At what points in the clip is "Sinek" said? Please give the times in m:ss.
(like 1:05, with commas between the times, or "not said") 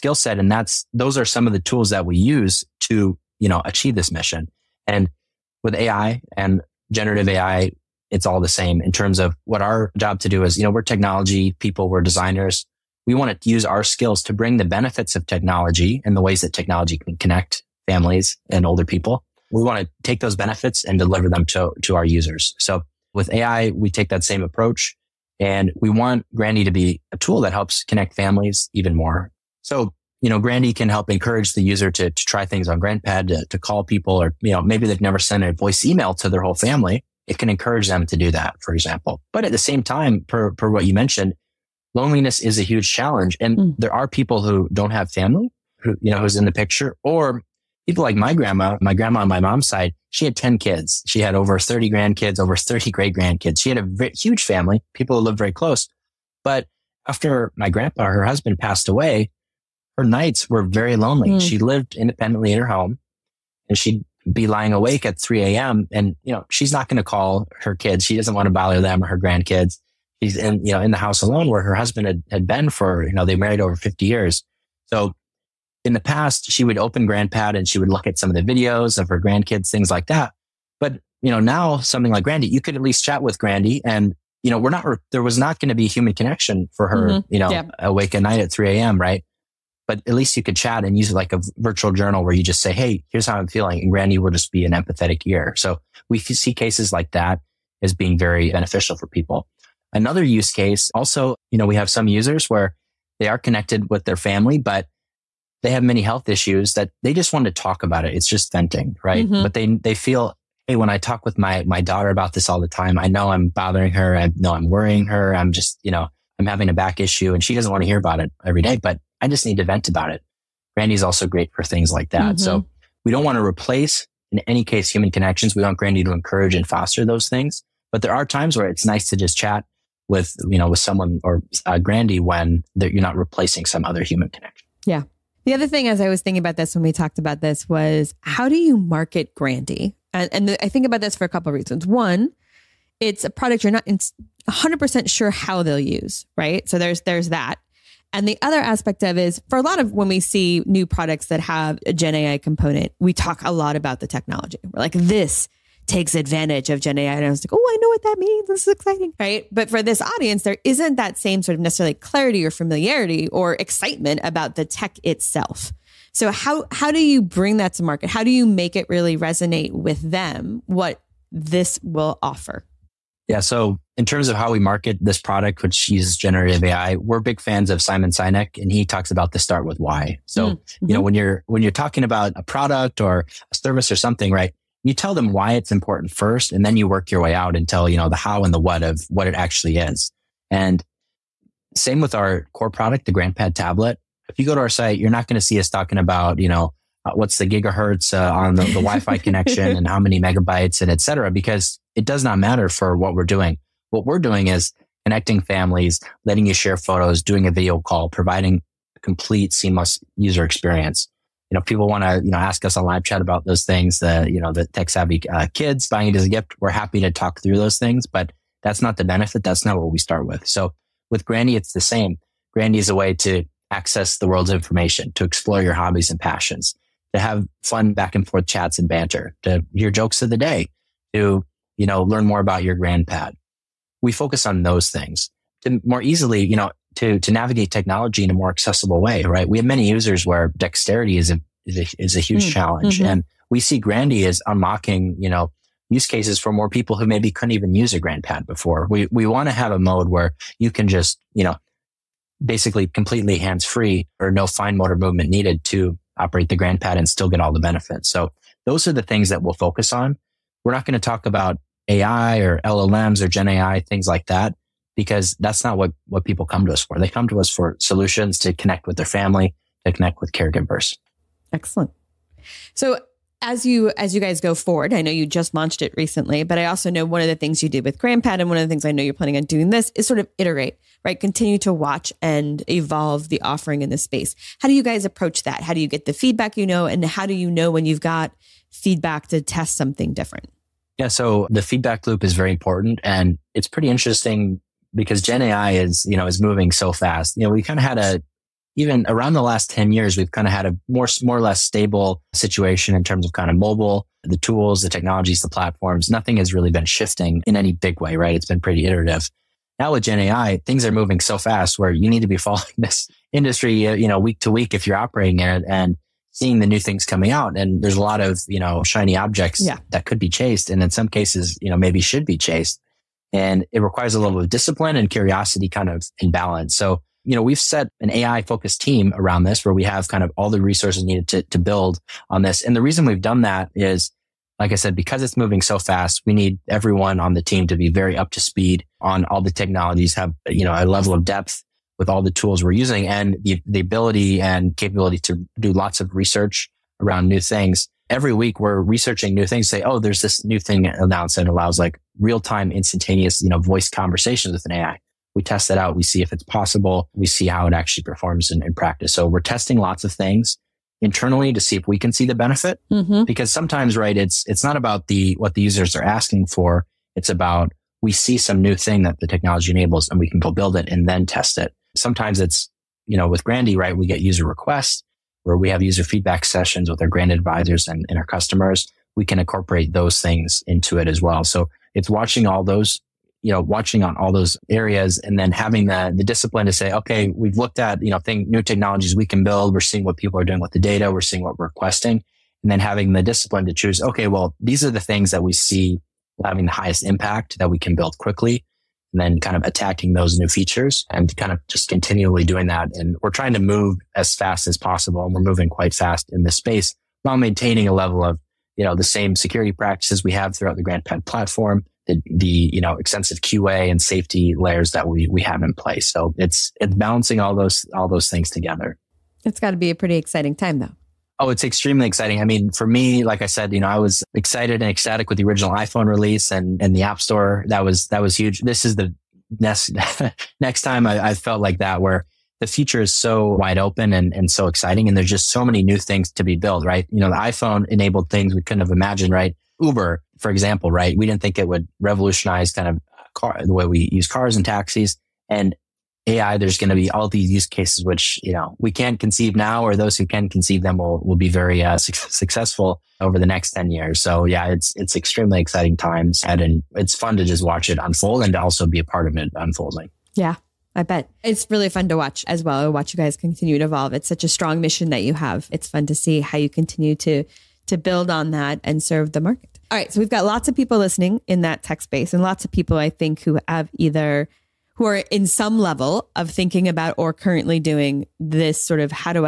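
2:58.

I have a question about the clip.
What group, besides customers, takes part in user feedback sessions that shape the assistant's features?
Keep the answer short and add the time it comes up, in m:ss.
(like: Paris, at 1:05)
Grand advisors, at 6:17.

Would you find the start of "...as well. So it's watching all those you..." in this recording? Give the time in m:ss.
6:21.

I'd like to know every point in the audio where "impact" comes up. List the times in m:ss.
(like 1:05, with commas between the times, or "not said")
6:37.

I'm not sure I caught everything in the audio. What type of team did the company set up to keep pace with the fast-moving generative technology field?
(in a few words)
AI focused team.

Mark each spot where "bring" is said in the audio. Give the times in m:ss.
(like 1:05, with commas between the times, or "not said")
0:14, 2:47.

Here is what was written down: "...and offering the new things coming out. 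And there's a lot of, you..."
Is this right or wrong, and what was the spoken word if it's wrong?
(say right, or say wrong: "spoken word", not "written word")
wrong: "seeing", not "offering".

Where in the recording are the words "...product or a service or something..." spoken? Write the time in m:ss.
3:02.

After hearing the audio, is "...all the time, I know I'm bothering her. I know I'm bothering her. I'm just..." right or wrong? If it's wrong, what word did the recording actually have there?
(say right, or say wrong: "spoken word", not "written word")
wrong: "worrying", not "bothering".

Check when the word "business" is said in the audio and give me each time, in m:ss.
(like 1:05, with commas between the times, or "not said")
not said.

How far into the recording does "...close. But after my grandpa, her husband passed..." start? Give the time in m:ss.
0:55.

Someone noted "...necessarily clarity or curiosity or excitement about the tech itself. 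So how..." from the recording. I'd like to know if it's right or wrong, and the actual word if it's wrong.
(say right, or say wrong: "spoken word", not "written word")
wrong: "familiarity", not "curiosity".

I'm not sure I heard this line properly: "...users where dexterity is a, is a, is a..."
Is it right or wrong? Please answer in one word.
right.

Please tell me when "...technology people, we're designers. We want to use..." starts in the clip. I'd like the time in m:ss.
0:10.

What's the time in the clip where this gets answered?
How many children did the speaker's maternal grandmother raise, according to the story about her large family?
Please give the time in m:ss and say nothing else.
0:50.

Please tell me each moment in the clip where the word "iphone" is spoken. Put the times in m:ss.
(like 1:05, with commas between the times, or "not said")
7:05, 7:17.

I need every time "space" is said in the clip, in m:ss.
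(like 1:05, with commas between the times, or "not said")
4:43, 6:46, 7:51.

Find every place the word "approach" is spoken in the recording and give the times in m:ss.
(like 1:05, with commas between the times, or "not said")
0:24, 4:45.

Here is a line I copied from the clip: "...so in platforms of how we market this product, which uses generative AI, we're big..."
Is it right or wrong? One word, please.
wrong.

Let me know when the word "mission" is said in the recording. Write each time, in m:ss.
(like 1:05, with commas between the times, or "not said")
0:04, 7:44.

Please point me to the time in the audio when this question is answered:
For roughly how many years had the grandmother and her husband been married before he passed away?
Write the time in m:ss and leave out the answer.
1:13.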